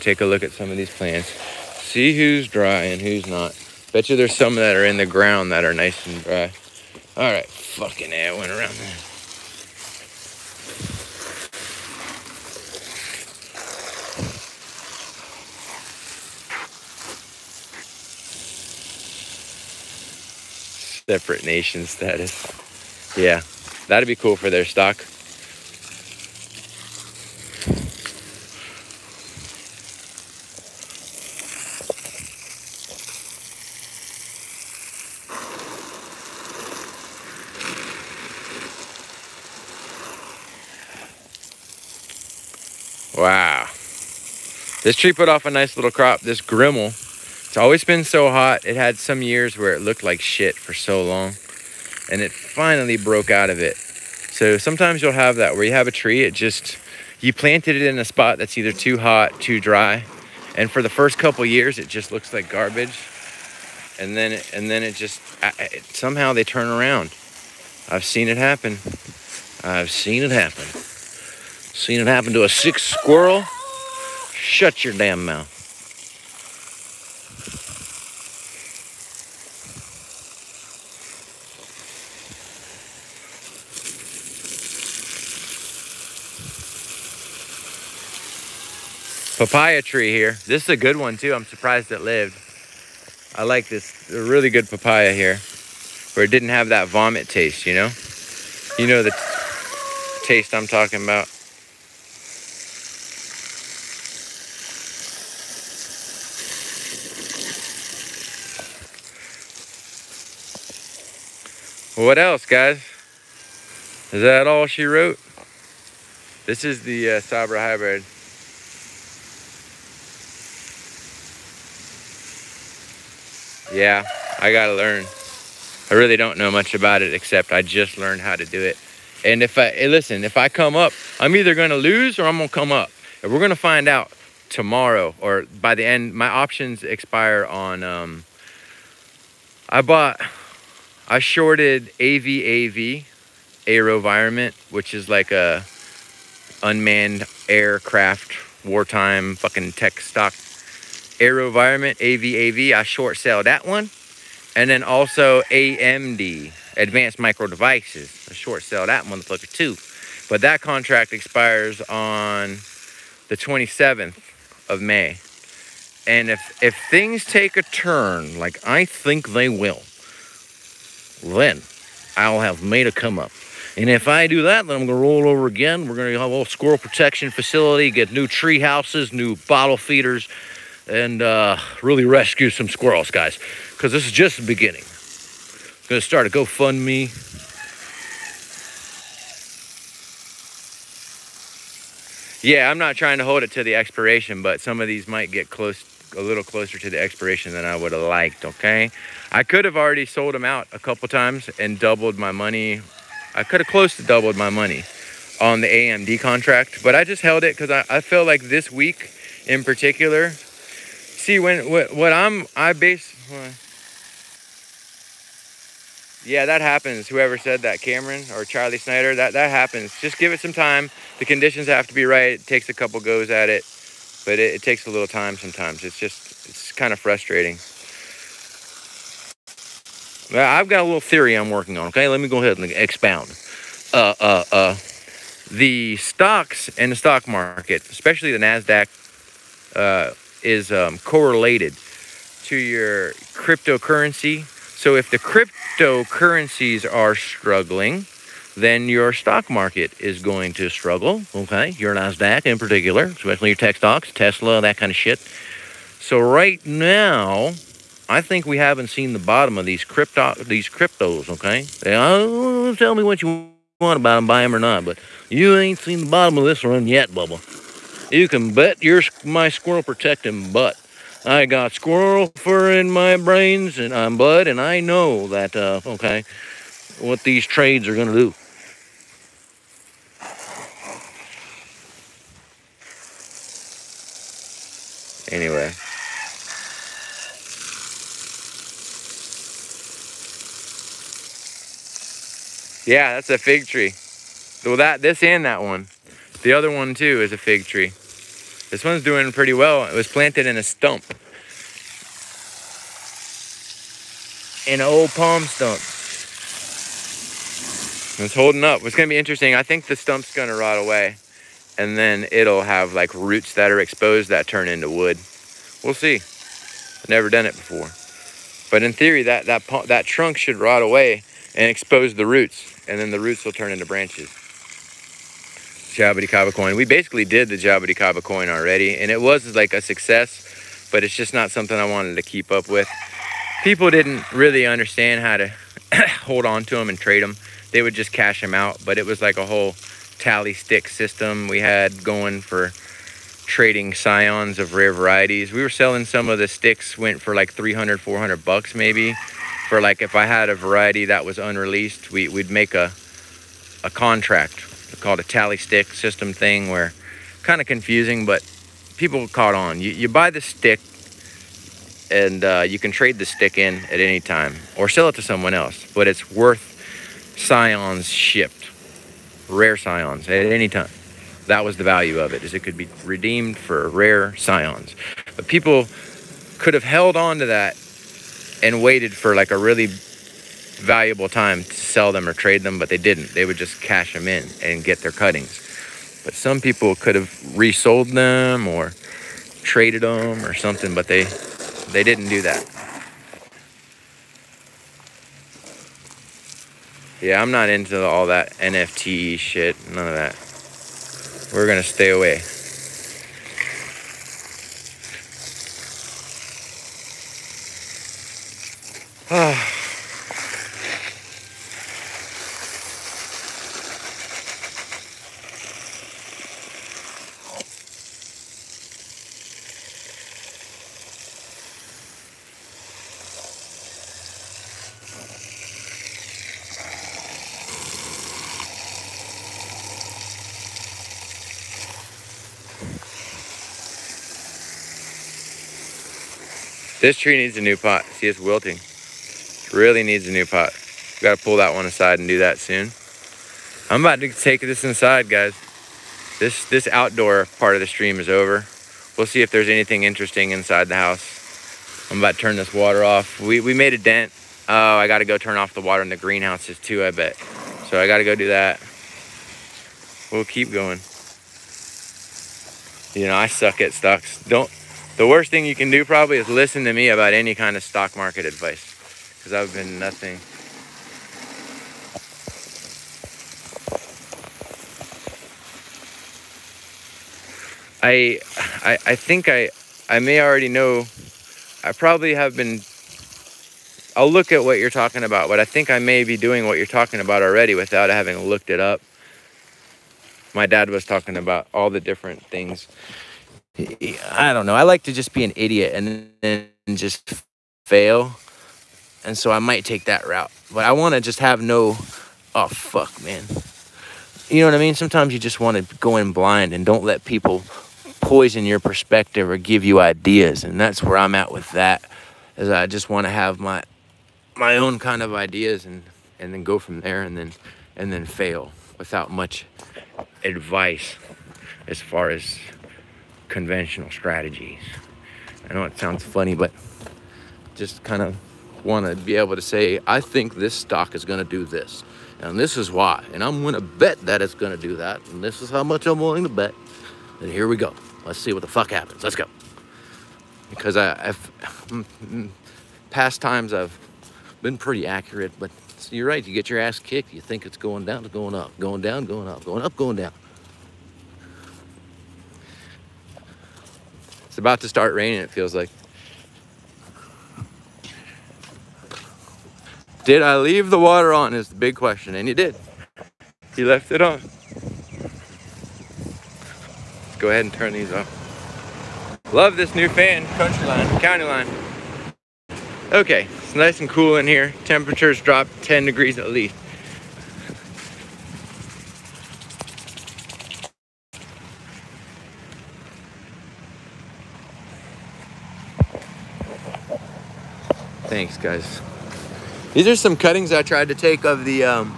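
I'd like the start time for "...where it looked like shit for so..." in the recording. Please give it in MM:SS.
00:49.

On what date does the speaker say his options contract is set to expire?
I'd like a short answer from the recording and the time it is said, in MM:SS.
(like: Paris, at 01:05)
May 27, at 02:43.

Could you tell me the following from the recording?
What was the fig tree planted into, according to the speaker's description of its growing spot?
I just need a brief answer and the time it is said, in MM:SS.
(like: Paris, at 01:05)
an old palm stump, at 05:04.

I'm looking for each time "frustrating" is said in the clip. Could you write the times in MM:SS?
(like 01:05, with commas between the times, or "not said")
03:46.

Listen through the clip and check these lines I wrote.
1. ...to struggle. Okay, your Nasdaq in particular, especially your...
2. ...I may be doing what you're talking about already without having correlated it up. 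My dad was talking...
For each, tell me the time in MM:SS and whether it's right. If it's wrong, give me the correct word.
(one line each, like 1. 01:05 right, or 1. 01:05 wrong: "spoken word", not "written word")
1. 04:10 right
2. 08:05 wrong: "looked", not "correlated".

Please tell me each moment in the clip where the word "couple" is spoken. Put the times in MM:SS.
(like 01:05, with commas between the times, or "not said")
01:01, 03:20, 03:42.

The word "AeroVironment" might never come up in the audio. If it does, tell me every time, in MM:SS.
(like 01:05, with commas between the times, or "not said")
02:23, 02:31.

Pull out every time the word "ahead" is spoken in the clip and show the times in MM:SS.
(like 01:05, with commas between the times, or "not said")
03:52, 09:27.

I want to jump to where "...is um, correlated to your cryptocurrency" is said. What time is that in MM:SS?
04:00.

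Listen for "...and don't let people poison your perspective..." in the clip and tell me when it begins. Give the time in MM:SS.
08:26.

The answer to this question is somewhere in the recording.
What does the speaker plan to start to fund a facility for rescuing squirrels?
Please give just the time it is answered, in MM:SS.
03:06.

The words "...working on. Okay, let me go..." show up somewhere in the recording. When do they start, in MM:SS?
03:51.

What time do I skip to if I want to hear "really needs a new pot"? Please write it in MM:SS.
07:19.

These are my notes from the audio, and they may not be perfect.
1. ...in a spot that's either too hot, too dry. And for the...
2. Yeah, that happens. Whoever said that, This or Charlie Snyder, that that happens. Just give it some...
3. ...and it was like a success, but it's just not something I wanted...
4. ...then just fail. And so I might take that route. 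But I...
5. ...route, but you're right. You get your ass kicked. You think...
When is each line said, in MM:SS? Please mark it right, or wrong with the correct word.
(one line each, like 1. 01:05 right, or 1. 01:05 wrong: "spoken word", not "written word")
1. 00:57 right
2. 03:36 wrong: "Cameron", not "This"
3. 05:28 right
4. 08:16 right
5. 09:05 wrong: "accurate", not "route".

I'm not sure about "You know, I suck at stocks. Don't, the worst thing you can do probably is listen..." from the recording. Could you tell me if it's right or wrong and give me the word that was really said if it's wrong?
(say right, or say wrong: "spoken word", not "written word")
right.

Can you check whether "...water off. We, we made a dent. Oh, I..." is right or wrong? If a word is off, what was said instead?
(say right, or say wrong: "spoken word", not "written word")
right.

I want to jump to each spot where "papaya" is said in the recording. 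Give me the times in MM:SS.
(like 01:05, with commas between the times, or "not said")
01:29, 01:34.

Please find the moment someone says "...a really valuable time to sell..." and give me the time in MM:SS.
06:19.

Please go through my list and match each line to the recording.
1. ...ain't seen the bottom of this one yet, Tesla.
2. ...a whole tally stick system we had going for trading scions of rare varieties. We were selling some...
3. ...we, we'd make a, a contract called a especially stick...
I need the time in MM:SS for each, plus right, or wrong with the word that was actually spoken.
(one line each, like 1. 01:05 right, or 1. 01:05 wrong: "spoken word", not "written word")
1. 04:25 wrong: "Bubba", not "Tesla"
2. 05:39 right
3. 05:52 wrong: "tally", not "especially".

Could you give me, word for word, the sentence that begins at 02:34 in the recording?
And then also AMD, Advanced Micro Devices.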